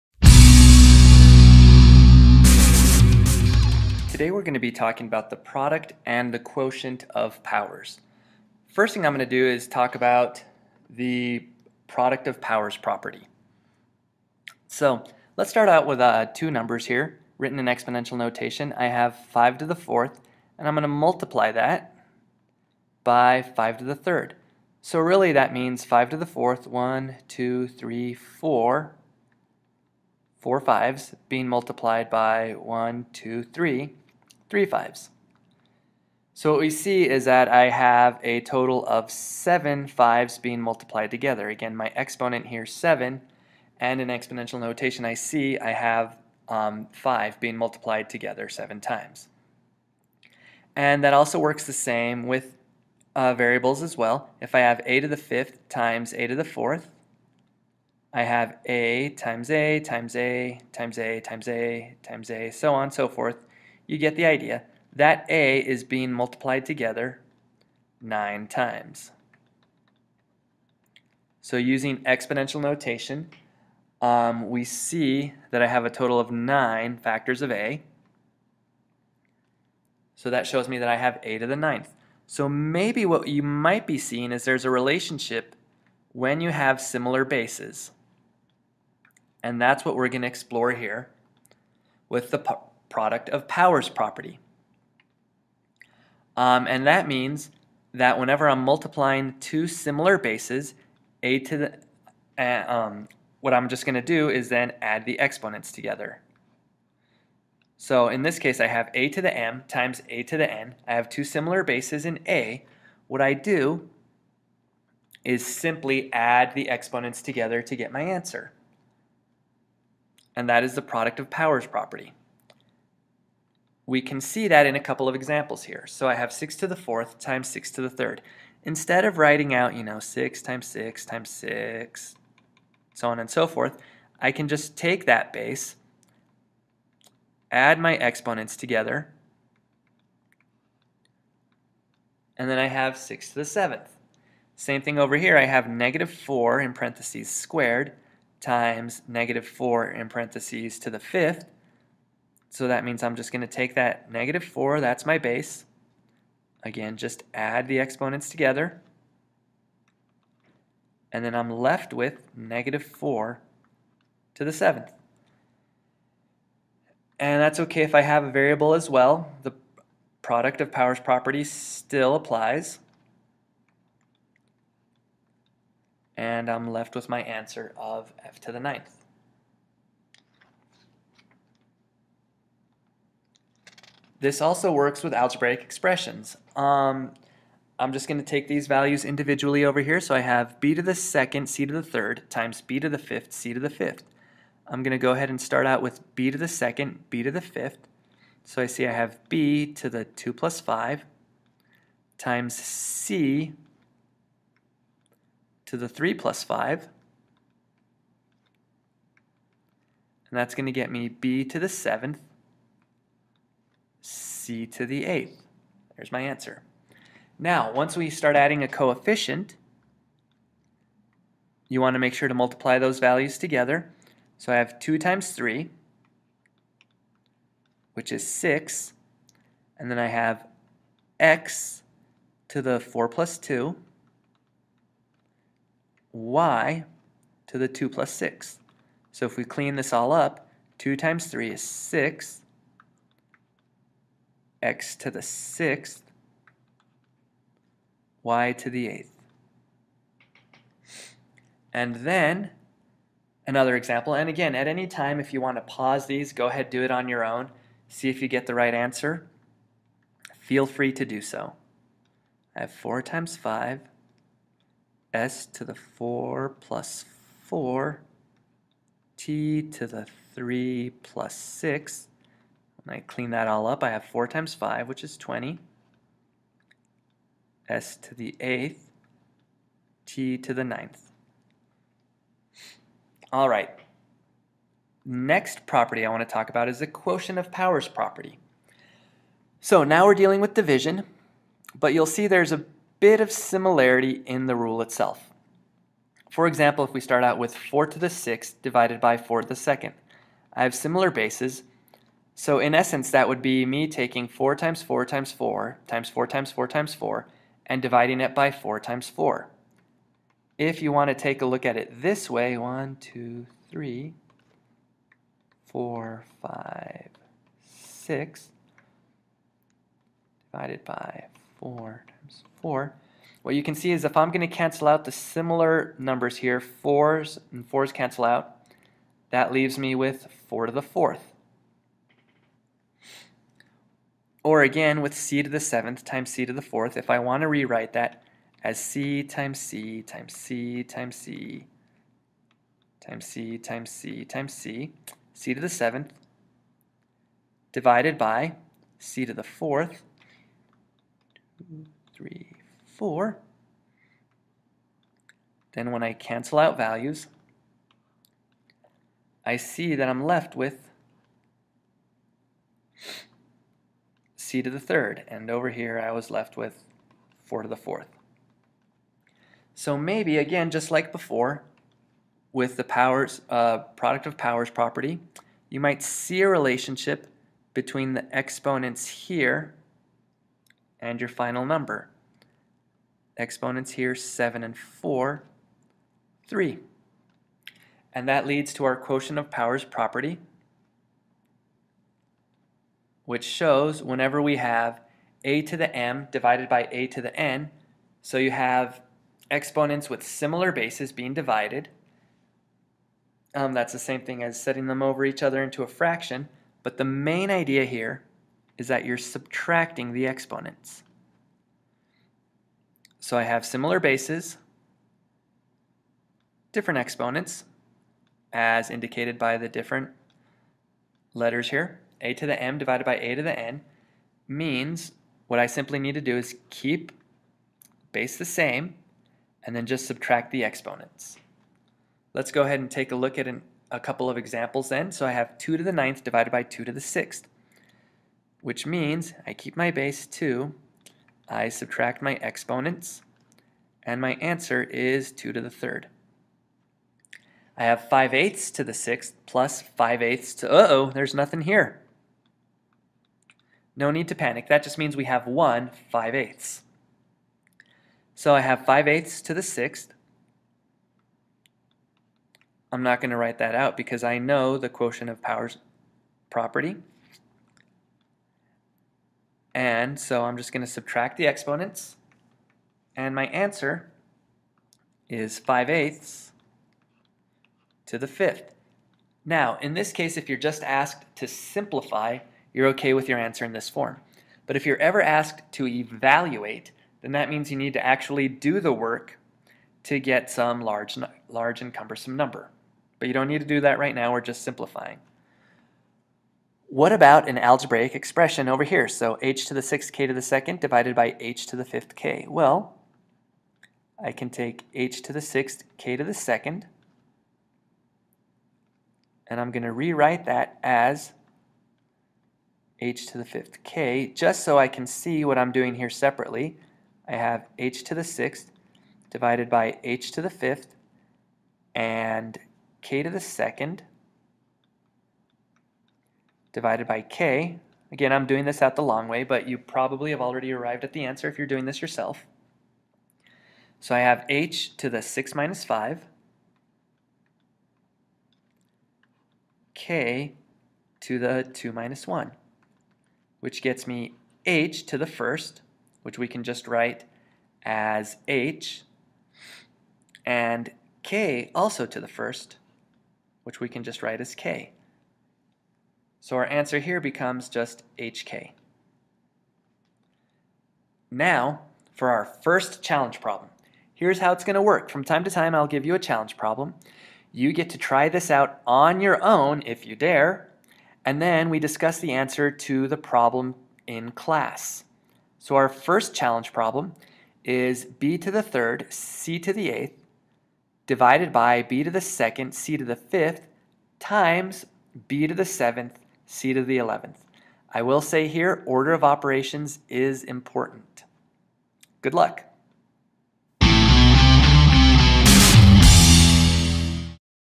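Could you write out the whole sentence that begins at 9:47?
I will say here, order of operations is important.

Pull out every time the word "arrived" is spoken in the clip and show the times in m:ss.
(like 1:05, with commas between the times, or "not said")
8:50.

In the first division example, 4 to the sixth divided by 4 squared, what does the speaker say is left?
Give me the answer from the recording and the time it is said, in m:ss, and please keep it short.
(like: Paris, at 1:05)
4 to the 4th, at 5:30.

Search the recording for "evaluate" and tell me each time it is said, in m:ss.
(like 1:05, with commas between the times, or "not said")
8:05.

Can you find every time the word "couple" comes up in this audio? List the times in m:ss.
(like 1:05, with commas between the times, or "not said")
2:04, 7:13.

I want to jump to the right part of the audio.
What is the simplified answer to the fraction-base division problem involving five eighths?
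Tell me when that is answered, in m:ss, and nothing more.
7:55.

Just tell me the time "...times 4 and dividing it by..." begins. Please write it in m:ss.
5:06.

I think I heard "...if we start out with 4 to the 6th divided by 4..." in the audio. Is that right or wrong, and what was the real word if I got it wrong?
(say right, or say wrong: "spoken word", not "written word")
right.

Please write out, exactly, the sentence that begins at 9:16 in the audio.
So our answer here becomes just hk.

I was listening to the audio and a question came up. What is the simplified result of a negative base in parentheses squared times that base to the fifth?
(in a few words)
negative 4 to the 7th.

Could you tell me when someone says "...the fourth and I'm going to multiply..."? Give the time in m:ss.
0:19.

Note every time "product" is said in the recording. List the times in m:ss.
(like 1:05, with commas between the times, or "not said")
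0:05, 0:11, 1:32, 2:00, 2:50, 6:14.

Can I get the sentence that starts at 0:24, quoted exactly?
So really that means 5 to the fourth, 1, 2, 3, 4, four fives being multiplied by one, two, three, three fives.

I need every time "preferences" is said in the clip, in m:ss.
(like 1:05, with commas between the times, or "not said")
not said.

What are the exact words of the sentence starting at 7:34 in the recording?
That just means we have 1 5 eighths.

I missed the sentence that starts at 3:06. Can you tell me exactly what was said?
Um, I'm just going to take these values individually over here.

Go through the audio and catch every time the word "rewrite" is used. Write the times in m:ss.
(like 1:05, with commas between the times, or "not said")
5:37, 8:29.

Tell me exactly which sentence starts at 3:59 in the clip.
So if we clean this all up, 2 times 3 is 6, x to the sixth, y to the eighth.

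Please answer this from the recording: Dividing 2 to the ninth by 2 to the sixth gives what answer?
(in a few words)
2 to the 3rd.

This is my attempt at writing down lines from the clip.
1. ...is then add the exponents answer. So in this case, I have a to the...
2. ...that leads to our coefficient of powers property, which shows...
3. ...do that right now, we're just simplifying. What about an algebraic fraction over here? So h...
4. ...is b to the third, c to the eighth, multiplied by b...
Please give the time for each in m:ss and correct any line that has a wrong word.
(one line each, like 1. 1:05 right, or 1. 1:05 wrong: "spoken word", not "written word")
1. 1:44 wrong: "together", not "answer"
2. 6:28 wrong: "quotient", not "coefficient"
3. 8:13 wrong: "expression", not "fraction"
4. 9:37 wrong: "divided", not "multiplied".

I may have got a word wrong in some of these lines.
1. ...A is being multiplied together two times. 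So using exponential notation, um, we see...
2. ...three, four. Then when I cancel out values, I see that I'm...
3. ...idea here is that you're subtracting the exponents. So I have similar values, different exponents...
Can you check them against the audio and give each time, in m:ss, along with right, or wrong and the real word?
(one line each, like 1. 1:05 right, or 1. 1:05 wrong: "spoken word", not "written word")
1. 1:05 wrong: "nine", not "two"
2. 5:52 right
3. 6:47 wrong: "bases", not "values".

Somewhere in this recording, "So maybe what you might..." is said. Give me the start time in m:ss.
1:22.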